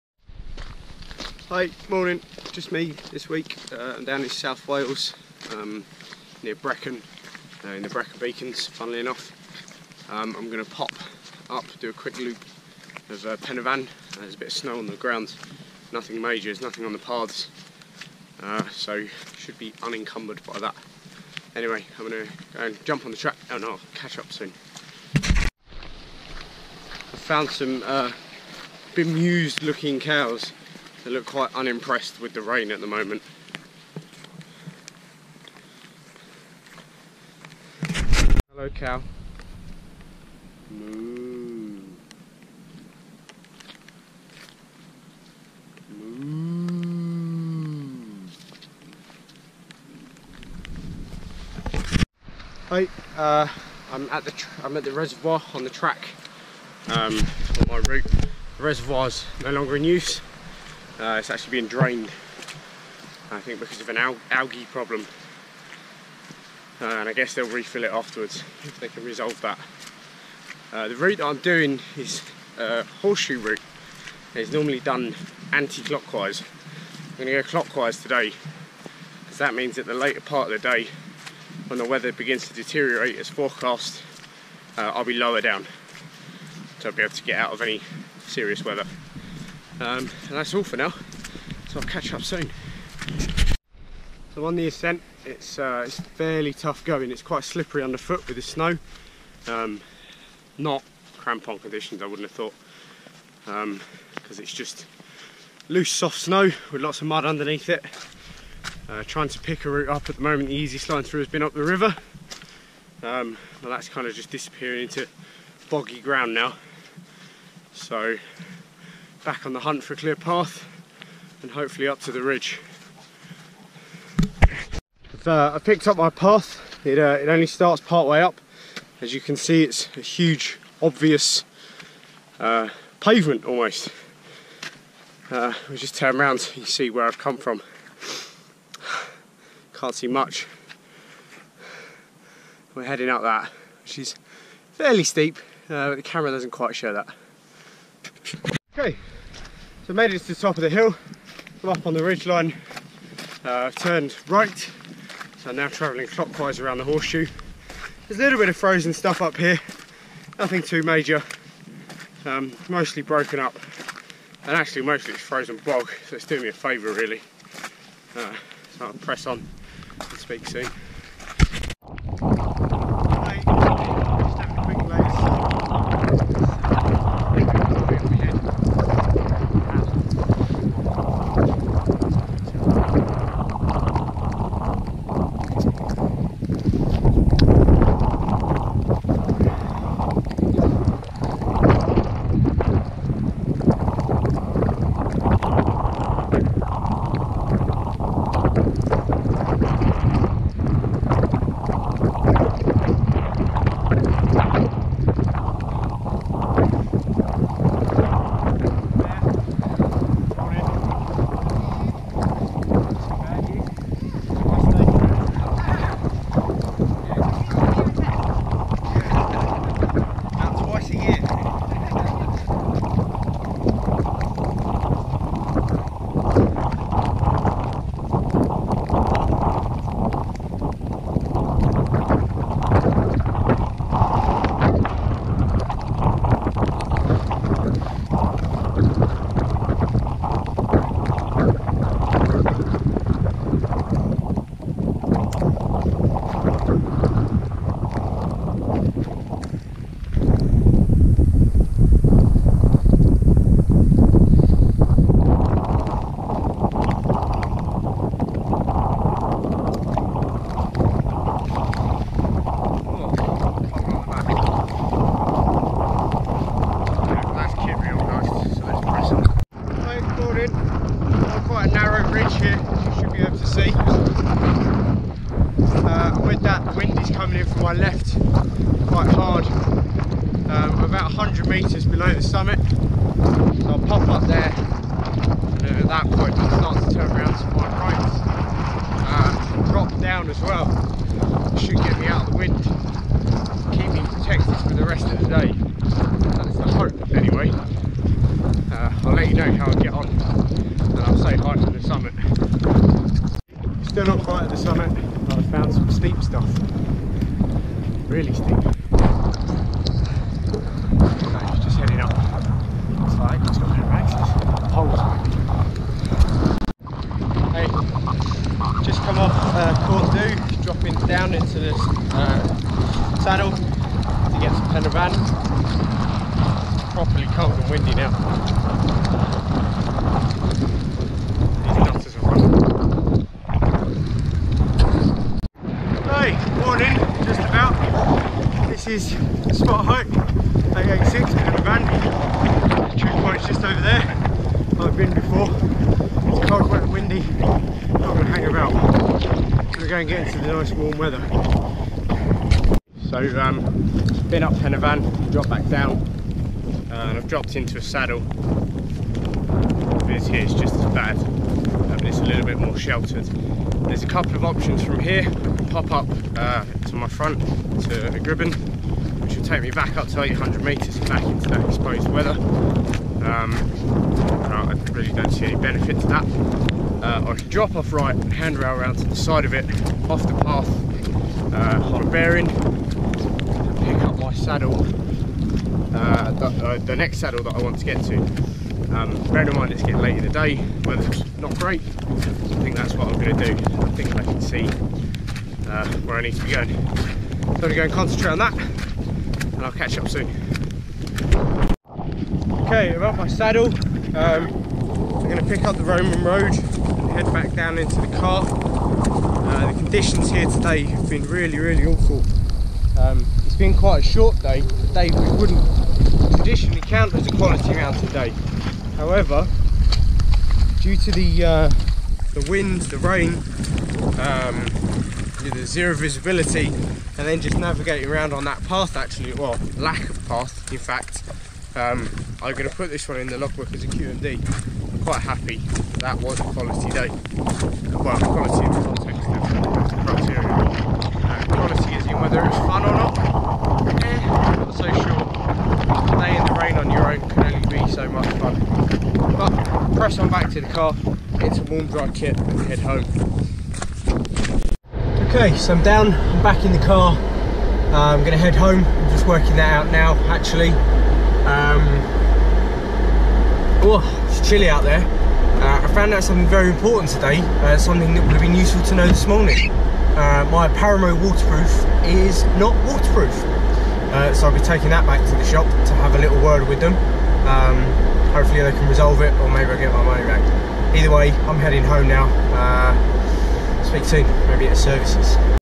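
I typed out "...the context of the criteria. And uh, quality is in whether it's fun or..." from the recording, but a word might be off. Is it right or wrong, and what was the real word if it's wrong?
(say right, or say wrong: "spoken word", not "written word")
right.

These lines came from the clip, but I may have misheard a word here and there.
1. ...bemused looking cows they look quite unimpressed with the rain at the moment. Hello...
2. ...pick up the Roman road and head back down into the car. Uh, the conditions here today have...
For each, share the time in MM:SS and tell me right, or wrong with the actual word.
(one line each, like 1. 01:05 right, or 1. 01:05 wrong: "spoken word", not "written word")
1. 00:28 right
2. 06:45 right.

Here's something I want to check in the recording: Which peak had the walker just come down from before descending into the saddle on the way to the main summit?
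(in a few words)
Corn Du.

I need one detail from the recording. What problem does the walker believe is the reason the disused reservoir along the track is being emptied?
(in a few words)
Algae.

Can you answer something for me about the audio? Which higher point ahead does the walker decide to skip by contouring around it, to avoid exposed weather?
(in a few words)
Cribyn.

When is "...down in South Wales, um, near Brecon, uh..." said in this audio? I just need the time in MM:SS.
00:04.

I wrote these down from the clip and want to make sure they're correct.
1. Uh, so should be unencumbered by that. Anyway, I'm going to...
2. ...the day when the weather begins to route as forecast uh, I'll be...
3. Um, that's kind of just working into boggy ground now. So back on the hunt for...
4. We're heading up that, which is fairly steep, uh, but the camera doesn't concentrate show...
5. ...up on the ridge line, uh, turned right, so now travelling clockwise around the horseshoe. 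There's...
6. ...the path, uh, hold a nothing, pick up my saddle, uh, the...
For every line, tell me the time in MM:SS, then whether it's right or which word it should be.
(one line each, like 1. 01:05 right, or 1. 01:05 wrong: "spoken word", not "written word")
1. 00:18 right
2. 01:20 wrong: "deteriorate", not "route"
3. 01:53 wrong: "disappearing", not "working"
4. 02:22 wrong: "quite", not "concentrate"
5. 02:31 right
6. 06:20 wrong: "bearing", not "nothing".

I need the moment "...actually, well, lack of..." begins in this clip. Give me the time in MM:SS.
07:08.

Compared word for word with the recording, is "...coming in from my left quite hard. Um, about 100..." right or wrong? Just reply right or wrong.
right.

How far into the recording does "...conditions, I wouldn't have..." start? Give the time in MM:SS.
01:41.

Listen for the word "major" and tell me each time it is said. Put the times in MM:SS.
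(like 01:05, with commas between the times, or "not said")
00:16, 02:40.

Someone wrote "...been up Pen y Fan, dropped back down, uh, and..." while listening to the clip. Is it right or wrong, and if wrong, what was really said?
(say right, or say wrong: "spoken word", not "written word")
right.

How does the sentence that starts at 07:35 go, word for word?
Okay, so I'm down, I'm back in the car.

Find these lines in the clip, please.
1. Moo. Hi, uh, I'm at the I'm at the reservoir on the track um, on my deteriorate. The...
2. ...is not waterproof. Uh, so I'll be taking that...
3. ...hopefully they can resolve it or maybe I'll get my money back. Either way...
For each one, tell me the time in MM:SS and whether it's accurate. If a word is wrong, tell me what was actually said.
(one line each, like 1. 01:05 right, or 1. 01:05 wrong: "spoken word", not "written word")
1. 00:45 wrong: "route", not "deteriorate"
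2. 07:52 right
3. 07:58 right.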